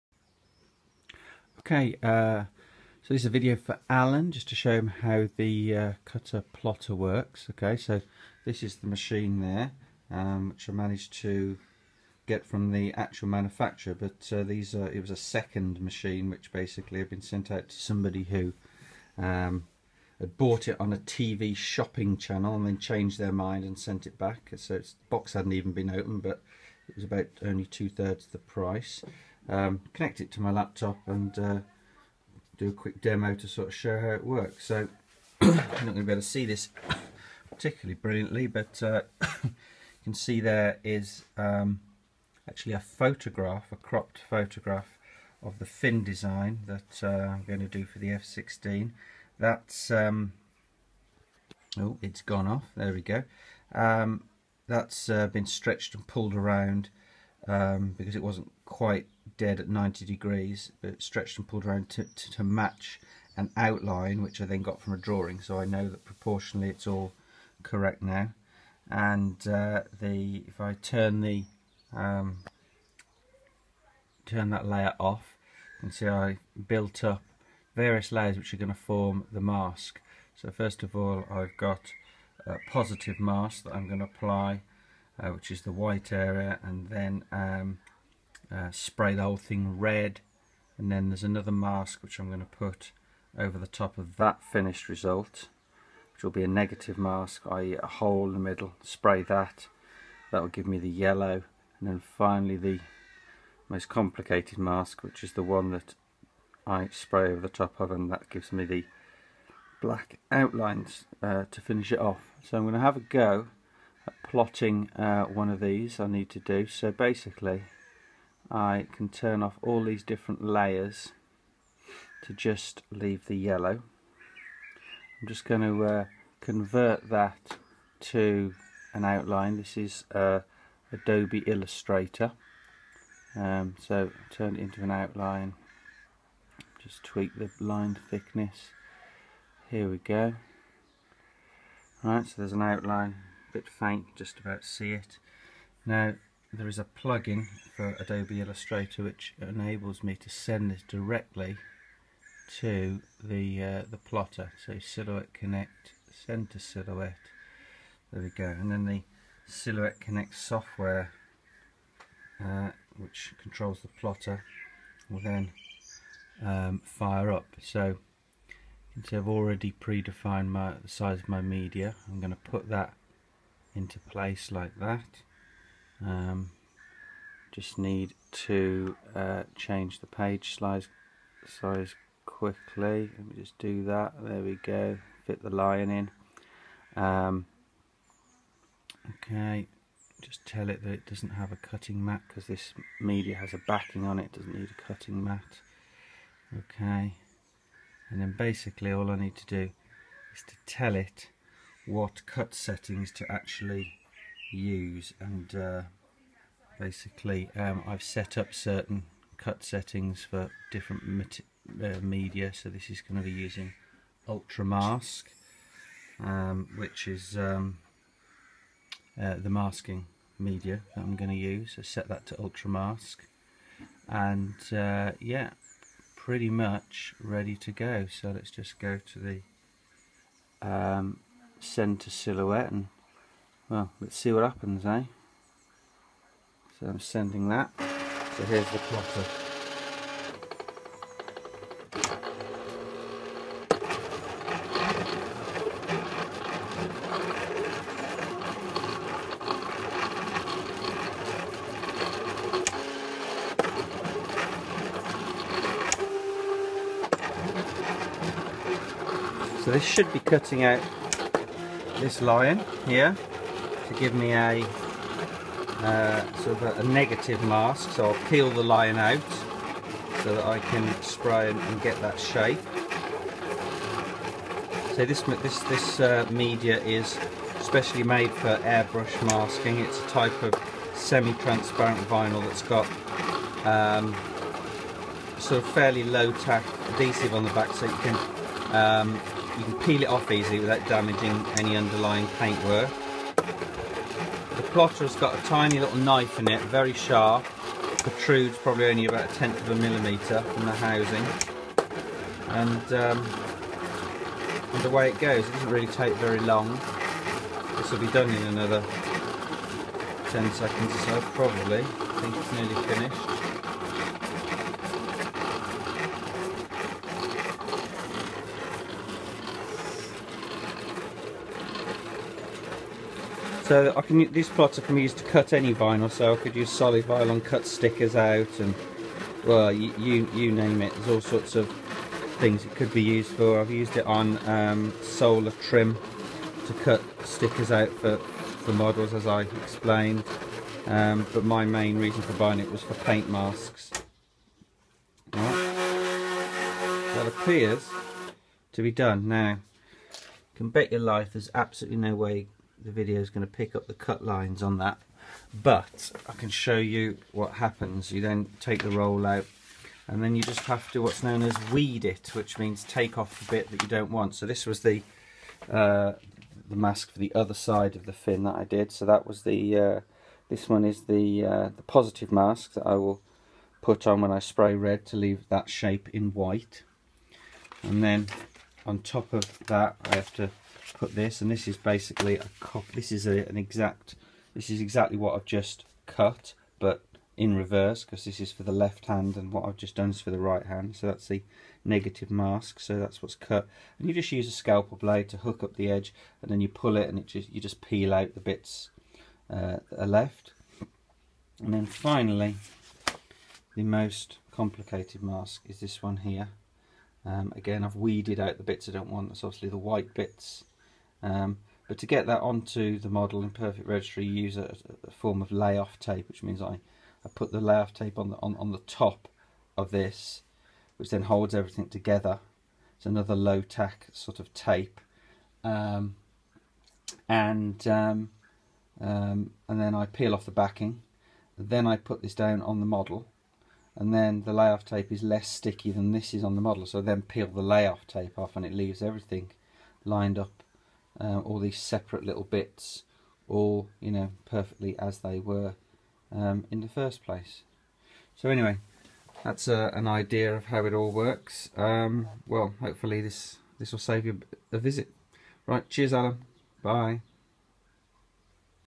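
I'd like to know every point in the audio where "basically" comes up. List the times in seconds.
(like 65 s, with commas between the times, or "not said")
16 s, 116 s, 198 s, 206 s, 381 s.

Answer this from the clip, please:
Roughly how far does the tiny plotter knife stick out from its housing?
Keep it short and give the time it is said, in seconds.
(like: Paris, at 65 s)
a tenth of a millimetre, at 299 s.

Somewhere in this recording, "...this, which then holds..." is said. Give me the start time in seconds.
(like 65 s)
419 s.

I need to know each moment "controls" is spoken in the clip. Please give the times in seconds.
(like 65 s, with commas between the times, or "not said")
163 s.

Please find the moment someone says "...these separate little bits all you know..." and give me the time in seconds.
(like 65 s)
441 s.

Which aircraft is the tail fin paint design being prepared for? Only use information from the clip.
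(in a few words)
F-16.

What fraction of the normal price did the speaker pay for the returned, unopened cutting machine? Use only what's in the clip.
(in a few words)
two-thirds.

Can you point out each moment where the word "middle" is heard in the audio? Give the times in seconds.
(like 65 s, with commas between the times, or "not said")
98 s.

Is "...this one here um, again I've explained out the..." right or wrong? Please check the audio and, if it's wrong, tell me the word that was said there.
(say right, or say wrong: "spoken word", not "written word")
wrong: "weeded", not "explained".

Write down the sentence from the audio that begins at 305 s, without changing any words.
It doesn't really take very long.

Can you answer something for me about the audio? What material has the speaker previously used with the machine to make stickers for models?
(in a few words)
solar trim.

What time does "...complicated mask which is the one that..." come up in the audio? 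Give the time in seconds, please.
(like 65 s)
103 s.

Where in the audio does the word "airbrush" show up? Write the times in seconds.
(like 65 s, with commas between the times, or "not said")
278 s.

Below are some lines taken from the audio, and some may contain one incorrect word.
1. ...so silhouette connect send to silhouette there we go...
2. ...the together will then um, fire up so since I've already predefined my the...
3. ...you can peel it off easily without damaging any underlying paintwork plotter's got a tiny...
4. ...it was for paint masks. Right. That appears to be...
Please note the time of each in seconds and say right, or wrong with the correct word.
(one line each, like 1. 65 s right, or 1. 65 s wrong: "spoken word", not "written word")
1. 154 s right
2. 163 s wrong: "plotter", not "together"
3. 289 s right
4. 342 s right.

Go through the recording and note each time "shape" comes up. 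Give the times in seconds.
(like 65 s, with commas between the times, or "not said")
272 s, 375 s.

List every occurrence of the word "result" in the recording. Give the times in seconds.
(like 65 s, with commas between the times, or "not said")
94 s.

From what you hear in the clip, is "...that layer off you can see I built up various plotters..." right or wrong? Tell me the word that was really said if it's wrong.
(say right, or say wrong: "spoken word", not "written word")
wrong: "layers", not "plotters".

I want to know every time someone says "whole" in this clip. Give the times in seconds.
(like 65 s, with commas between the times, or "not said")
89 s.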